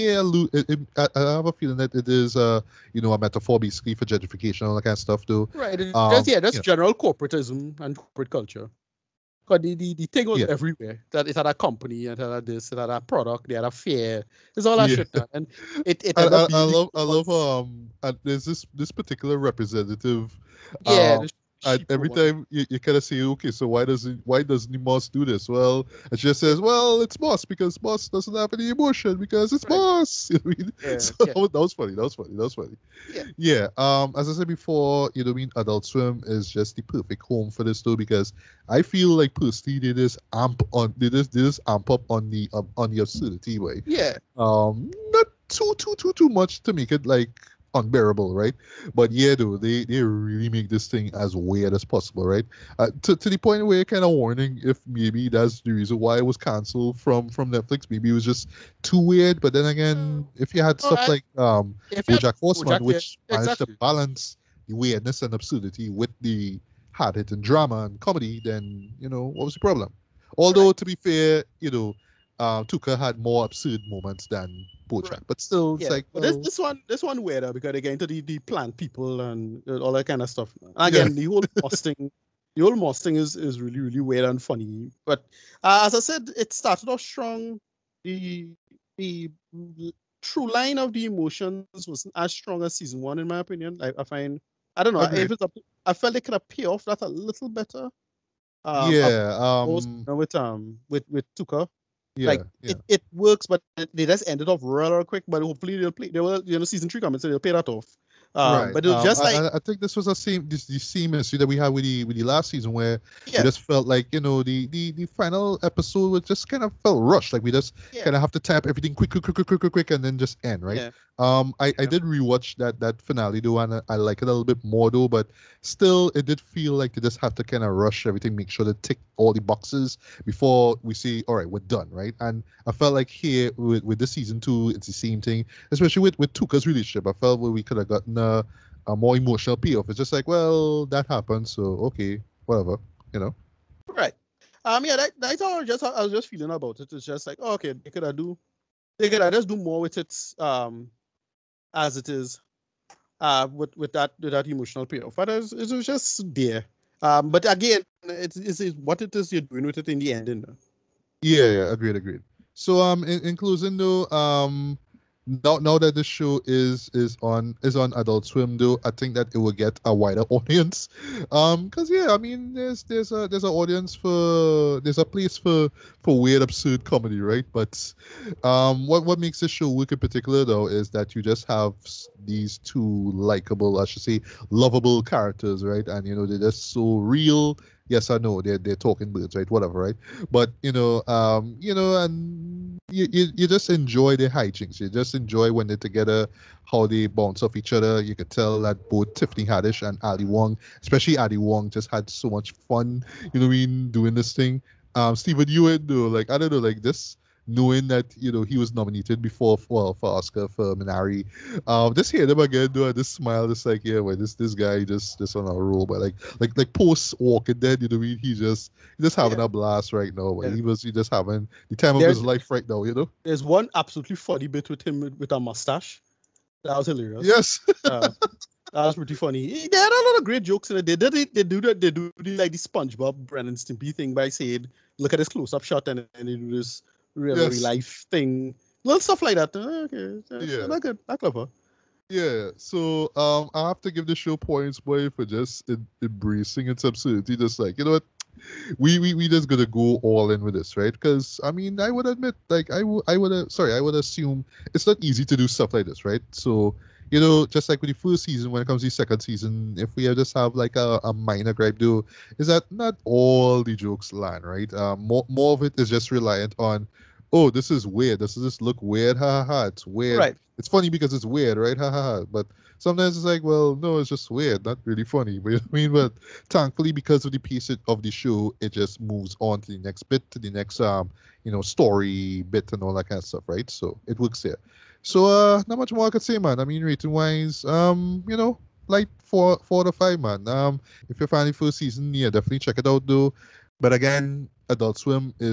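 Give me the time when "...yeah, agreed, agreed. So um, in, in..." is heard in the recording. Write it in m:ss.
2:41.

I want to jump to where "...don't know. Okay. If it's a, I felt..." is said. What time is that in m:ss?
1:34.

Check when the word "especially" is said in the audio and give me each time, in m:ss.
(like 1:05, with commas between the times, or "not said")
2:15, 3:20.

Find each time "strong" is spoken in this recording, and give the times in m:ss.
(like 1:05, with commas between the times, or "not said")
1:27, 1:32.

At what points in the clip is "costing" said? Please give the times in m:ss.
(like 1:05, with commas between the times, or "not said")
1:21.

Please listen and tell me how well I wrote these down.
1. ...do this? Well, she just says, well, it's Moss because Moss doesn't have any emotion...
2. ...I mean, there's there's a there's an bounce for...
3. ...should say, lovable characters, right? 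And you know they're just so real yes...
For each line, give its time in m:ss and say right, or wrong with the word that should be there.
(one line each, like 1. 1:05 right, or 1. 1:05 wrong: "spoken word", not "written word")
1. 0:25 right
2. 2:52 wrong: "audience", not "bounce"
3. 3:03 right.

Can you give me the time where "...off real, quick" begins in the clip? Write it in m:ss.
1:44.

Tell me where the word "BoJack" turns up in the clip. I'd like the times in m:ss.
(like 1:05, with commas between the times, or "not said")
1:01, 1:14.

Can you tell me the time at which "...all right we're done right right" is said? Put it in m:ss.
2:11.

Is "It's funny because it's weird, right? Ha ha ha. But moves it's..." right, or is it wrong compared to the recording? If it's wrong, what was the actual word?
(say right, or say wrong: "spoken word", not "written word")
wrong: "sometimes", not "moves".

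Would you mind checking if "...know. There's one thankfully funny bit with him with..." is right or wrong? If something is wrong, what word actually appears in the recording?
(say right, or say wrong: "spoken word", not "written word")
wrong: "absolutely", not "thankfully".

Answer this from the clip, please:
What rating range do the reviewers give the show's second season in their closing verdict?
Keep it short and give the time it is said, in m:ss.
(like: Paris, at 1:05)
4 to 5, at 4:49.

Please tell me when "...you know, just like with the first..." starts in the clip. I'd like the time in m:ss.
4:17.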